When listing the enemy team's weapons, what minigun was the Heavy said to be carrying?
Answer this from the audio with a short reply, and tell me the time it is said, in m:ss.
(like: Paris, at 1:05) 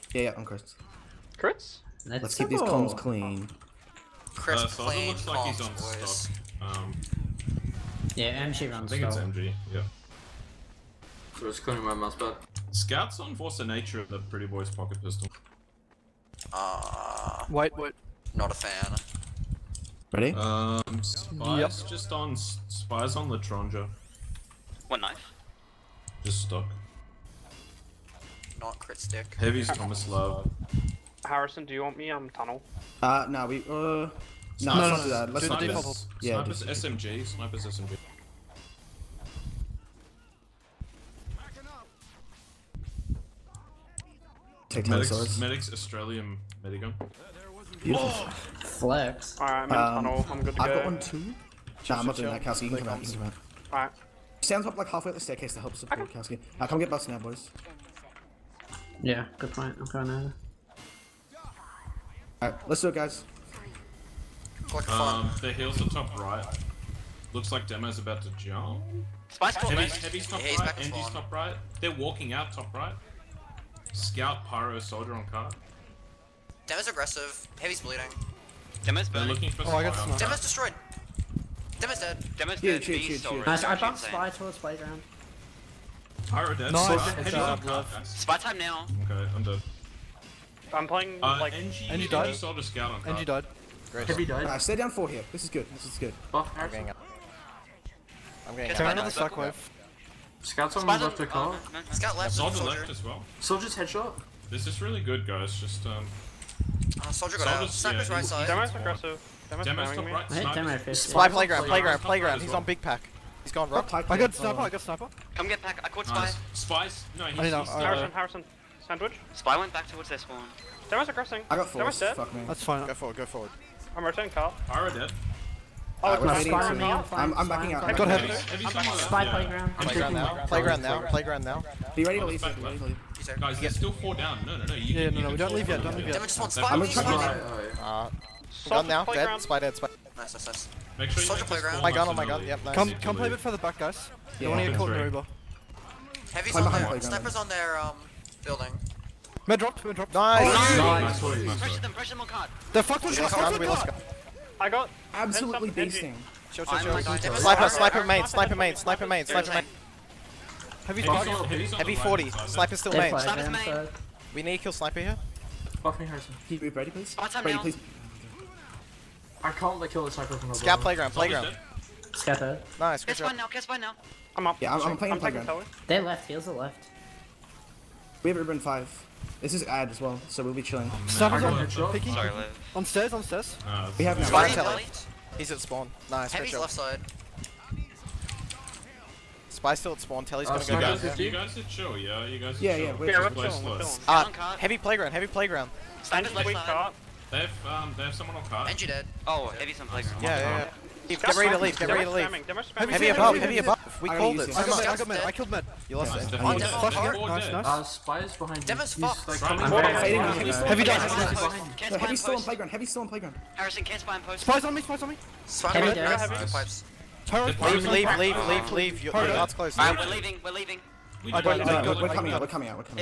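Tomislav, at 0:29.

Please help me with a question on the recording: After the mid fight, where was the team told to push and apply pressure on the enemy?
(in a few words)
card.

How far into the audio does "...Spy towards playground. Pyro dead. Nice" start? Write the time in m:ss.
1:24.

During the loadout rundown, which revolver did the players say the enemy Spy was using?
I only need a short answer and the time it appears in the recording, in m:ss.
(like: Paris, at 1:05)
L'Etranger, at 0:23.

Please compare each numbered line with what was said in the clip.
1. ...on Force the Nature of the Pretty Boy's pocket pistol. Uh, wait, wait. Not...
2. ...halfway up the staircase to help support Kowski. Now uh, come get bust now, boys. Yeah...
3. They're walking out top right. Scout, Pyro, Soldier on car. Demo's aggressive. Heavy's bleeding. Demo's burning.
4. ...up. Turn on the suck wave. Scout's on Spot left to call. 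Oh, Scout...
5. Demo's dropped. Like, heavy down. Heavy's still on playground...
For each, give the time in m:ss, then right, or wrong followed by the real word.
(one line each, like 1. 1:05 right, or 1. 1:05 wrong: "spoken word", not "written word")
1. 0:13 right
2. 0:54 right
3. 1:11 right
4. 1:38 right
5. 3:28 wrong: "fucked", not "dropped".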